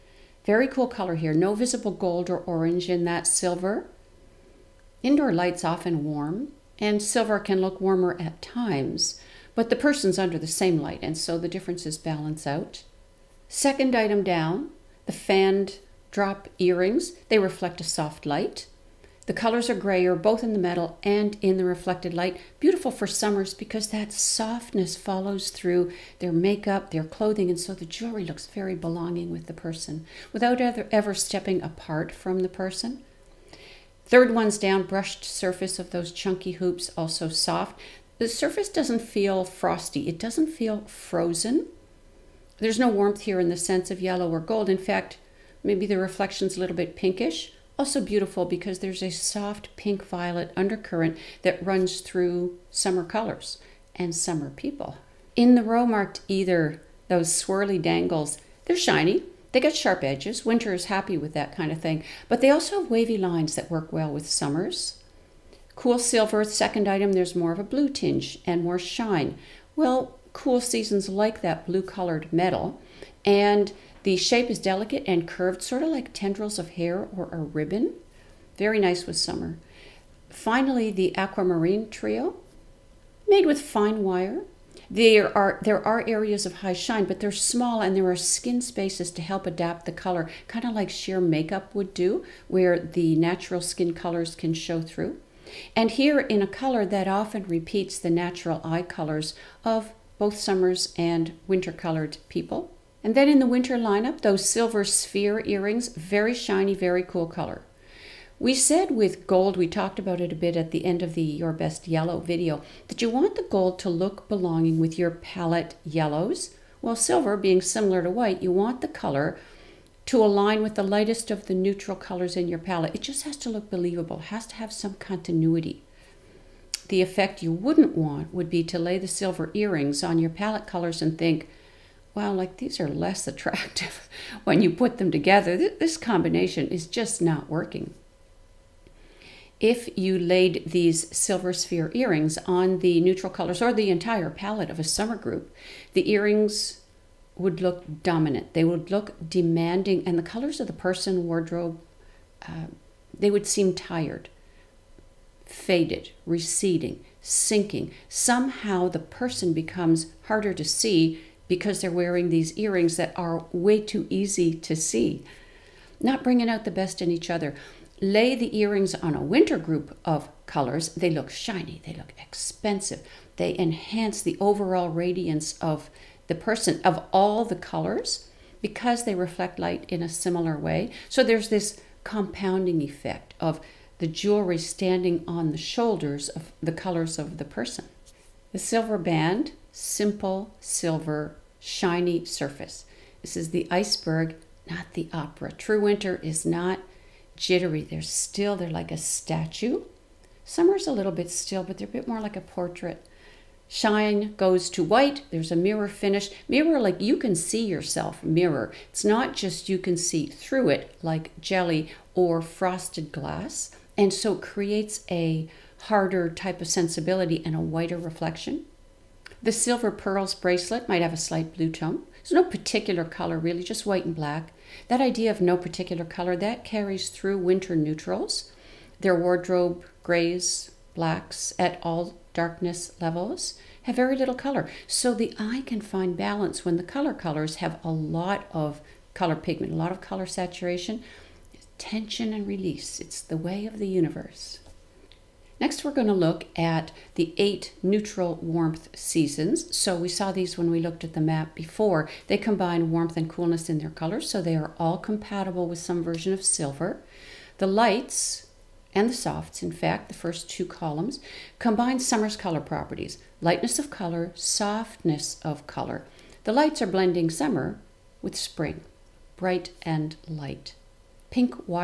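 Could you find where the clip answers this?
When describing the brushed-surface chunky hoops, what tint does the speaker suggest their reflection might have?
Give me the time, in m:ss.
0:46.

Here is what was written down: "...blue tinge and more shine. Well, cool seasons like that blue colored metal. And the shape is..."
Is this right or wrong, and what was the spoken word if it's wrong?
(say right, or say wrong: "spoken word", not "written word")
right.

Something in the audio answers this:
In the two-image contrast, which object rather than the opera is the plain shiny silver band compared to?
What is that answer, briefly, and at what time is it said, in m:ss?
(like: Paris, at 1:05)
The iceberg, at 3:13.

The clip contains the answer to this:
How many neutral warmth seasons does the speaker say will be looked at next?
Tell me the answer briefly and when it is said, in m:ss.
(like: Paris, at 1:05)
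8, at 4:07.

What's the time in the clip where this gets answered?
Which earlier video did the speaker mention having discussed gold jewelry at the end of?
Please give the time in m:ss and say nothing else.
1:51.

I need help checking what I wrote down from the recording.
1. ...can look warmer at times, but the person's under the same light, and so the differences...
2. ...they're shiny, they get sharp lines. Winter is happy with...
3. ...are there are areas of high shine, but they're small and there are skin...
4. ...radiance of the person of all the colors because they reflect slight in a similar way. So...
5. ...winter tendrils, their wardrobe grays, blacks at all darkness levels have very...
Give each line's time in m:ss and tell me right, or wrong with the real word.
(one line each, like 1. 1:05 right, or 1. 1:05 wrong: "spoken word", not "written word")
1. 0:07 right
2. 0:58 wrong: "edges", not "lines"
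3. 1:25 right
4. 2:54 wrong: "light", not "slight"
5. 3:47 wrong: "neutrals", not "tendrils".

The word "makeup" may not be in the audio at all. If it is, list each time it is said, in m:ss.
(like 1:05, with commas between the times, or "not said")
0:26, 1:31.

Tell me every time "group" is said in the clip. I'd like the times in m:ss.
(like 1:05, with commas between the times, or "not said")
2:25, 2:49.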